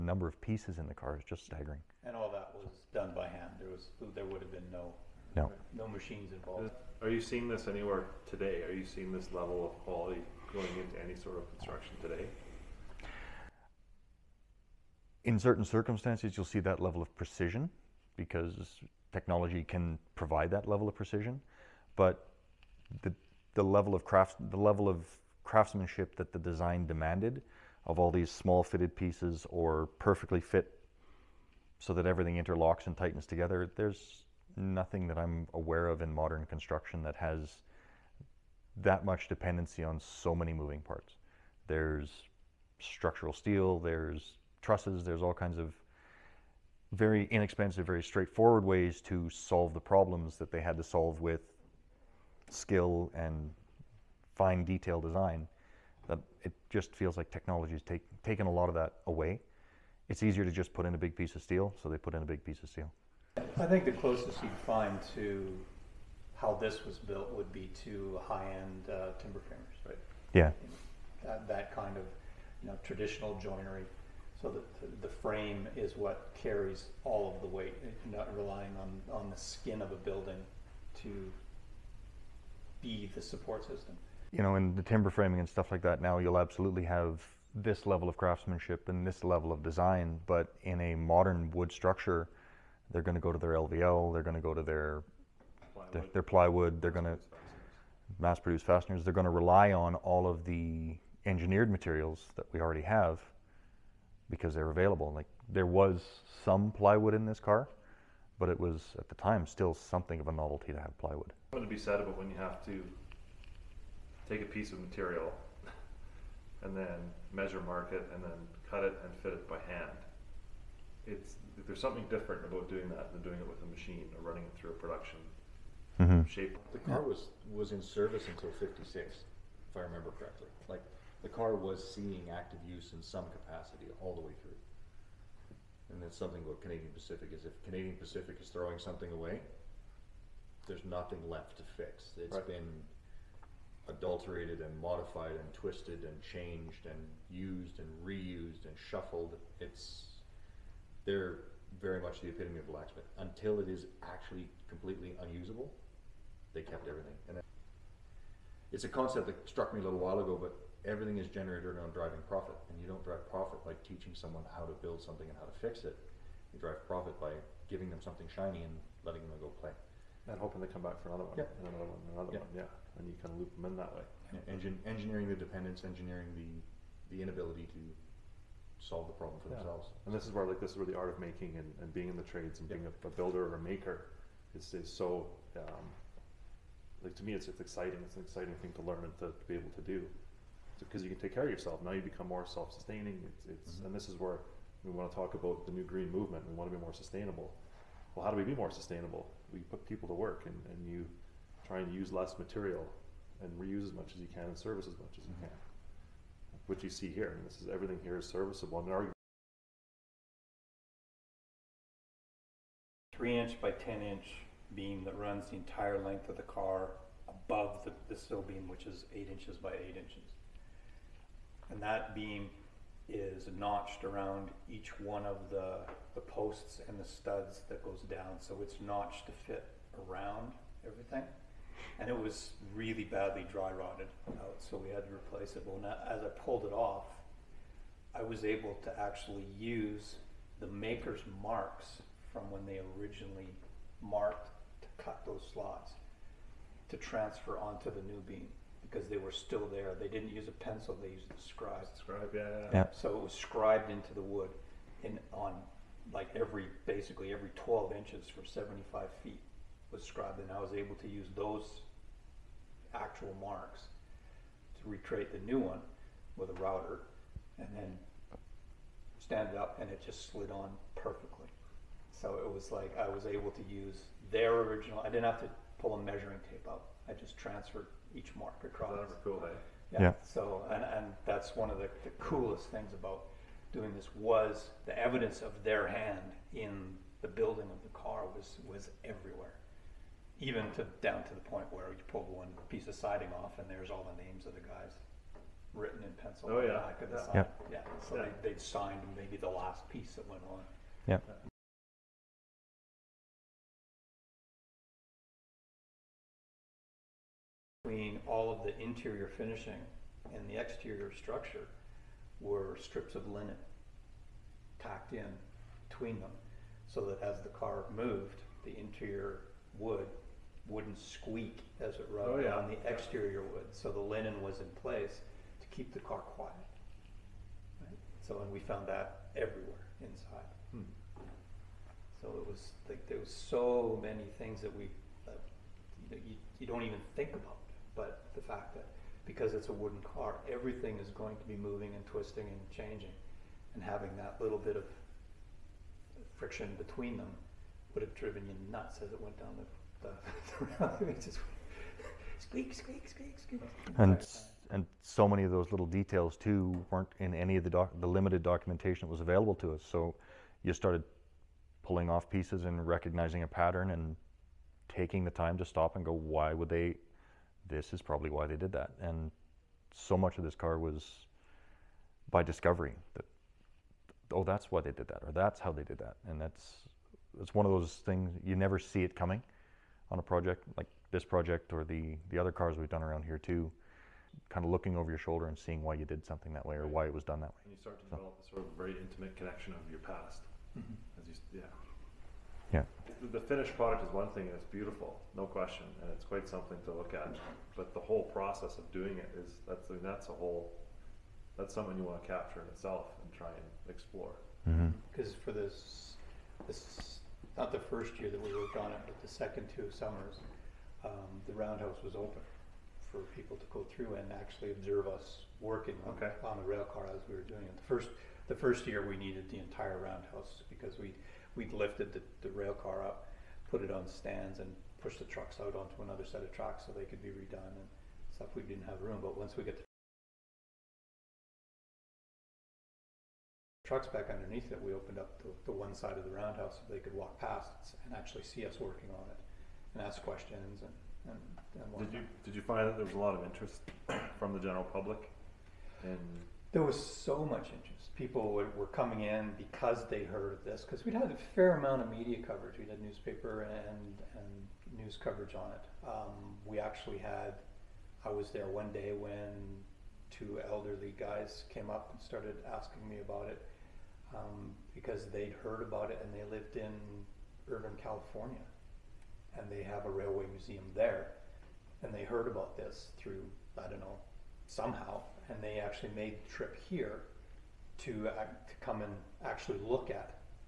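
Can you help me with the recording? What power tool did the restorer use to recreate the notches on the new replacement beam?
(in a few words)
A router.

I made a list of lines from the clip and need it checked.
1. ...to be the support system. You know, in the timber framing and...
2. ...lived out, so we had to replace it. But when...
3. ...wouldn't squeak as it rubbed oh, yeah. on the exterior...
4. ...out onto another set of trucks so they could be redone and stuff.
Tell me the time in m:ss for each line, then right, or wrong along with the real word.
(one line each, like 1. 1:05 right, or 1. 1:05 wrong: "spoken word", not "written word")
1. 1:21 right
2. 3:53 wrong: "rotted", not "lived"
3. 5:20 right
4. 7:05 wrong: "tracks", not "trucks".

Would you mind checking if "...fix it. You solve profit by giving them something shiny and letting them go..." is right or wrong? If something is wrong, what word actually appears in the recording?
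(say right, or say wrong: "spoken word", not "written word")
wrong: "drive", not "solve".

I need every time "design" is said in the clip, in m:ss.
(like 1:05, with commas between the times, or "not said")
0:26, 0:55, 1:29.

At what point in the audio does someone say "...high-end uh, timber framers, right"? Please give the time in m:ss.
1:08.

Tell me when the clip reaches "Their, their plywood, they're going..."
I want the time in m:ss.
1:35.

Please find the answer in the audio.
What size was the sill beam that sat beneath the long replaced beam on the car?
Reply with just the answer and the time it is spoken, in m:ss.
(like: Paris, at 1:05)
8 inches by 8 inches, at 3:39.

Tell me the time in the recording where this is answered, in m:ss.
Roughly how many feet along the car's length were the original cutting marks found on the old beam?
4:18.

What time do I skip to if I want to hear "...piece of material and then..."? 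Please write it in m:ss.
1:54.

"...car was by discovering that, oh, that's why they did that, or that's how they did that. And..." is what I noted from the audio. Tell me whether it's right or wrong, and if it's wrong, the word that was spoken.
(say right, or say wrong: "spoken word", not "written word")
right.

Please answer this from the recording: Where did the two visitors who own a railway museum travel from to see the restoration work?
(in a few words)
California.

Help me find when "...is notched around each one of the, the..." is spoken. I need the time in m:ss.
3:43.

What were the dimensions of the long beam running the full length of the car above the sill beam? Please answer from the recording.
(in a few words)
3 inch by 10 inch.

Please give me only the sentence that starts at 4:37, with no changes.
I just transferred each mark across.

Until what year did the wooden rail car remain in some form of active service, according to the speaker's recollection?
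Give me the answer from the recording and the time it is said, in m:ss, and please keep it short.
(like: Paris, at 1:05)
1956, at 2:08.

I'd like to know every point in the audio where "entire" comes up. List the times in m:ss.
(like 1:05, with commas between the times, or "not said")
3:35, 6:59.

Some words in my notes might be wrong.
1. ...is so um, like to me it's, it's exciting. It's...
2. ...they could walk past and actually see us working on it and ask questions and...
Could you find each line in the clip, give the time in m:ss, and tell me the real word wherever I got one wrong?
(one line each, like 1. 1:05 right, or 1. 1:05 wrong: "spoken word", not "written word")
1. 3:04 right
2. 7:16 right.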